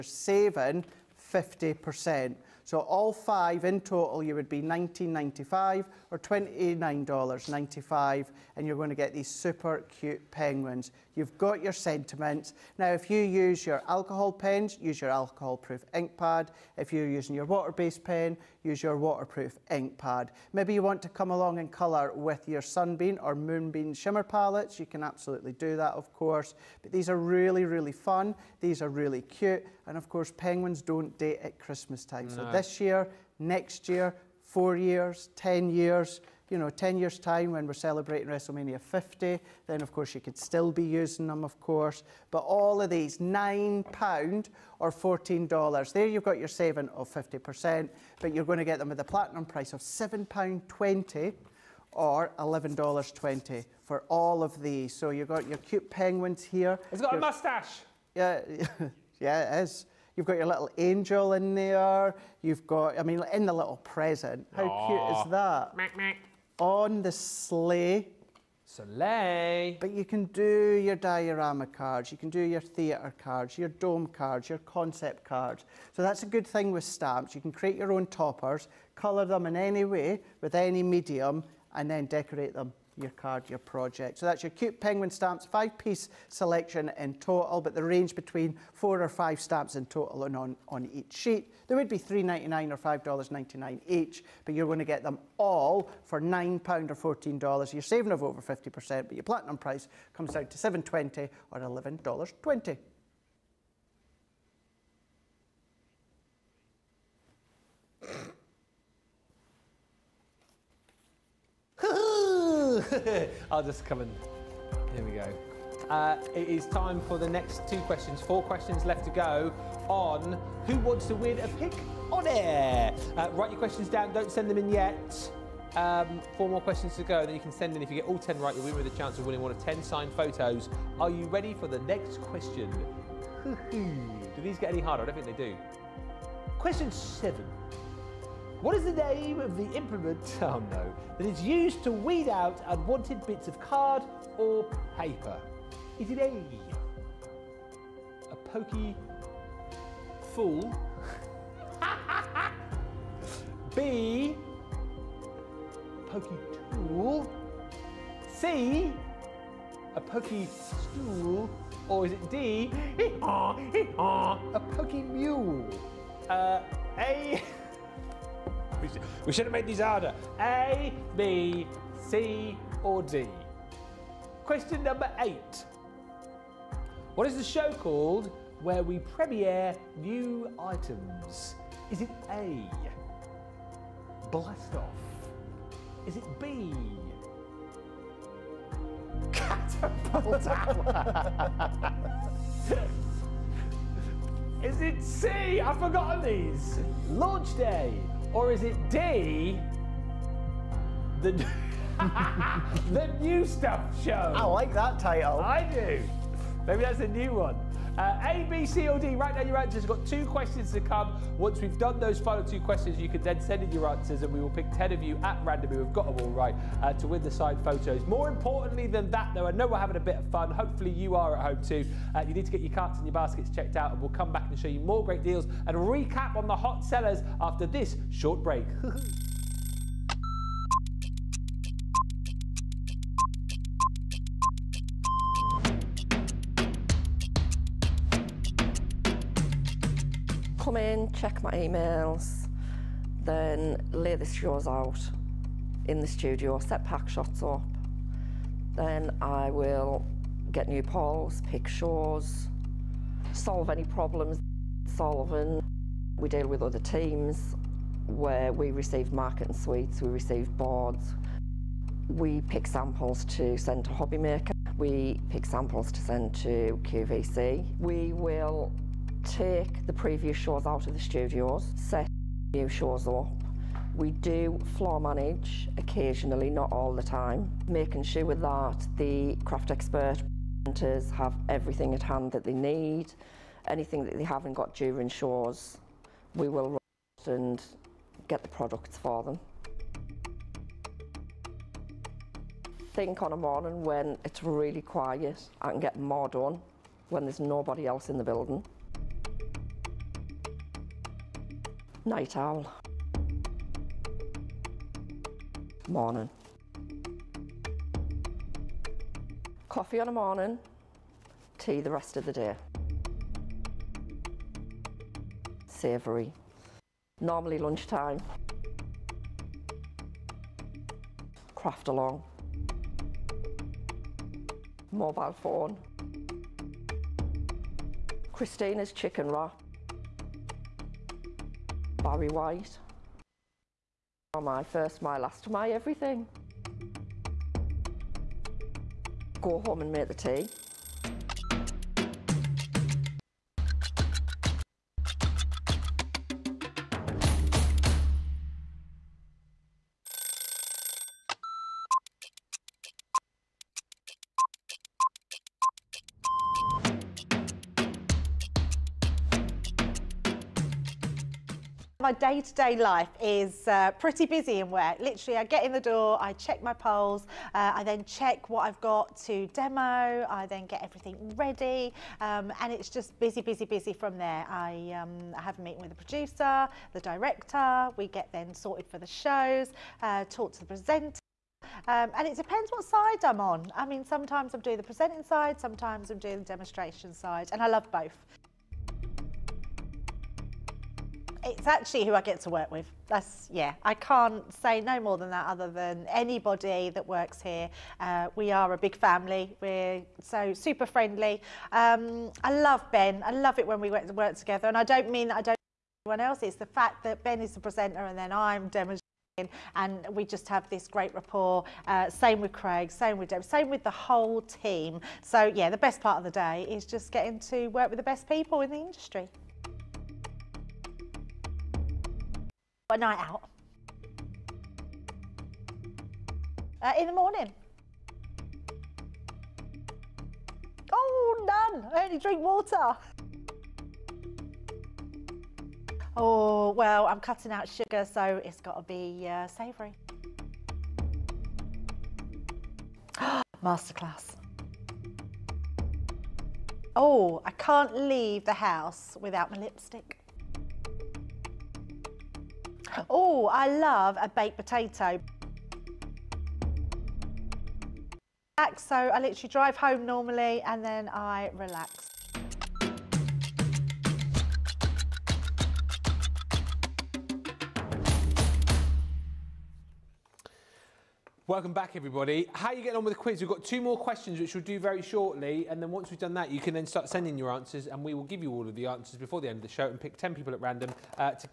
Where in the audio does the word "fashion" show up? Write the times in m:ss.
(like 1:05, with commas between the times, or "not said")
not said.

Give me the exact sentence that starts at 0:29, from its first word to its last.
And of course, penguins don't date at Christmas time.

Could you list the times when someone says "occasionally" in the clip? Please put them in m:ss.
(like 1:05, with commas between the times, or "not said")
4:35.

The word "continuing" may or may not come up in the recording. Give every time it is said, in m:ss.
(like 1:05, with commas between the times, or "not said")
not said.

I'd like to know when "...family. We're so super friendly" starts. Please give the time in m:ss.
6:38.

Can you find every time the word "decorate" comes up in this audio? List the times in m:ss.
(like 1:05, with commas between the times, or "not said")
1:22.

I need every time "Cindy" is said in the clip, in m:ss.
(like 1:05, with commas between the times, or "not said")
not said.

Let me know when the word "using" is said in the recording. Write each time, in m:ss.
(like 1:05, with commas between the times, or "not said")
0:17, 0:40.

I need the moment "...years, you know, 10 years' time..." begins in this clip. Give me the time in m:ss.
0:35.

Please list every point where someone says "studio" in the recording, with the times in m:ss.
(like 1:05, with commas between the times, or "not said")
4:06, 4:30.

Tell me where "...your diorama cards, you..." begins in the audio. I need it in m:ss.
1:10.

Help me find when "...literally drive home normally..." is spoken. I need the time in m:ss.
7:39.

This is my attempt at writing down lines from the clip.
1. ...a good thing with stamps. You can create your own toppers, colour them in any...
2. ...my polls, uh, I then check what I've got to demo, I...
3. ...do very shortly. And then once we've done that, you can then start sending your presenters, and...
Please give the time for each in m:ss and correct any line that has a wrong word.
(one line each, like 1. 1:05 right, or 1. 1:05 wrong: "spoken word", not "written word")
1. 1:16 right
2. 6:06 right
3. 7:54 wrong: "answers", not "presenters".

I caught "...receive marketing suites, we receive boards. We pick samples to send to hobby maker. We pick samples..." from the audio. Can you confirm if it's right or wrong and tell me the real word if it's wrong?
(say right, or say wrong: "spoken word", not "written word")
right.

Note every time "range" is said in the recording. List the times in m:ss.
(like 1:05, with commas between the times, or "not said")
1:27.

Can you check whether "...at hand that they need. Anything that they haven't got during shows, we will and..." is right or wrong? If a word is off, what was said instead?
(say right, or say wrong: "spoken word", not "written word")
right.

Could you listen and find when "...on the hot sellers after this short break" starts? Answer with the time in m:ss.
3:46.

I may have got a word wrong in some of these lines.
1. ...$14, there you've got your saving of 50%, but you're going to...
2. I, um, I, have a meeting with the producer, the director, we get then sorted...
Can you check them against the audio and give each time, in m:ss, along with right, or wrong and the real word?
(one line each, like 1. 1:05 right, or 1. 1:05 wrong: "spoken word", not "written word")
1. 0:44 right
2. 6:14 right.